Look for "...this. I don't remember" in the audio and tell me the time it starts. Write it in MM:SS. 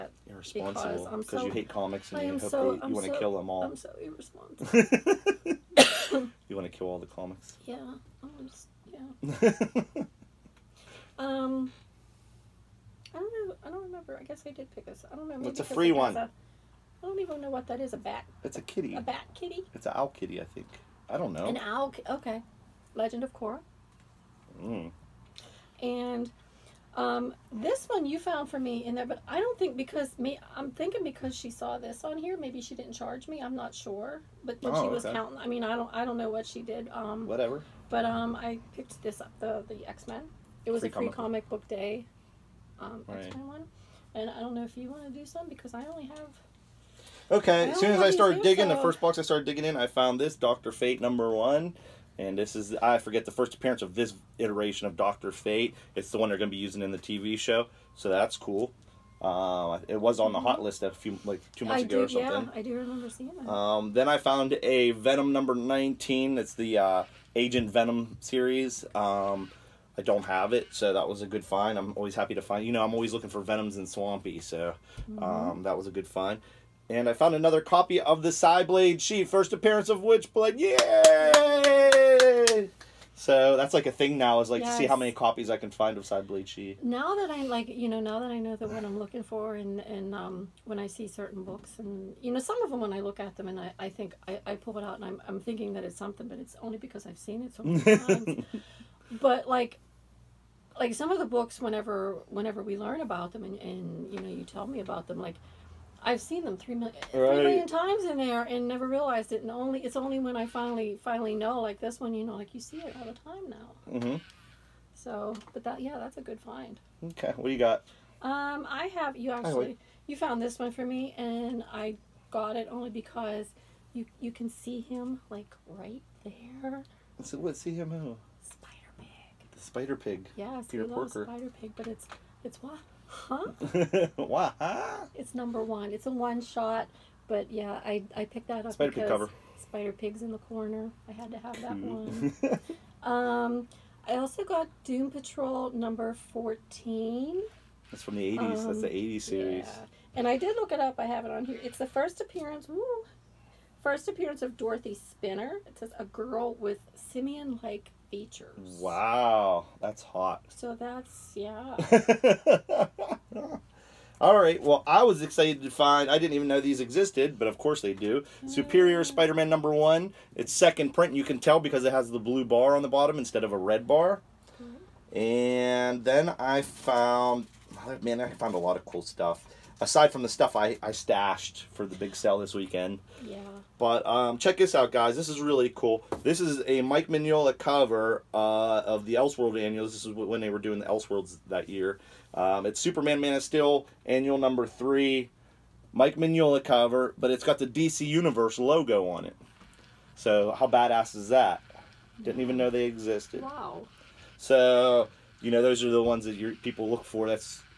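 00:14.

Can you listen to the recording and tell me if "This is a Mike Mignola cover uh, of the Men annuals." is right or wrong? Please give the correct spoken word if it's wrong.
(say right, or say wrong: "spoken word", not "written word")
wrong: "Elseworld", not "Men".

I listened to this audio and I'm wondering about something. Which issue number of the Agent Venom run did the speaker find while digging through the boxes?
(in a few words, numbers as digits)
19.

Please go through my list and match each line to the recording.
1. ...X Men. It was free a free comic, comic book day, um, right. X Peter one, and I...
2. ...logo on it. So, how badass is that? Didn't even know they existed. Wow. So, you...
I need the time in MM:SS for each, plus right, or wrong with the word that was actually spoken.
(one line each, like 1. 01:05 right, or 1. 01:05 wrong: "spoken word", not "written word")
1. 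00:39 wrong: "Men", not "Peter"
2. 03:18 right.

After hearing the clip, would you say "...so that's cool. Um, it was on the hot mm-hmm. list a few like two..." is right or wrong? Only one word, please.
right.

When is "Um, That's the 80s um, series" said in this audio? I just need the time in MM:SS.
02:28.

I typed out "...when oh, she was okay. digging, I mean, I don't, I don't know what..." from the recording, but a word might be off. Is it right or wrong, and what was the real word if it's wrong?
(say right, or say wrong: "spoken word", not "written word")
wrong: "counting", not "digging".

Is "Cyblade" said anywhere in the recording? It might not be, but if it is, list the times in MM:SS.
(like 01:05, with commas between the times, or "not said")
01:18, 01:26.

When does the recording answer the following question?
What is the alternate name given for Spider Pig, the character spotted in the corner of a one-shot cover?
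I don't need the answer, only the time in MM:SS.
02:10.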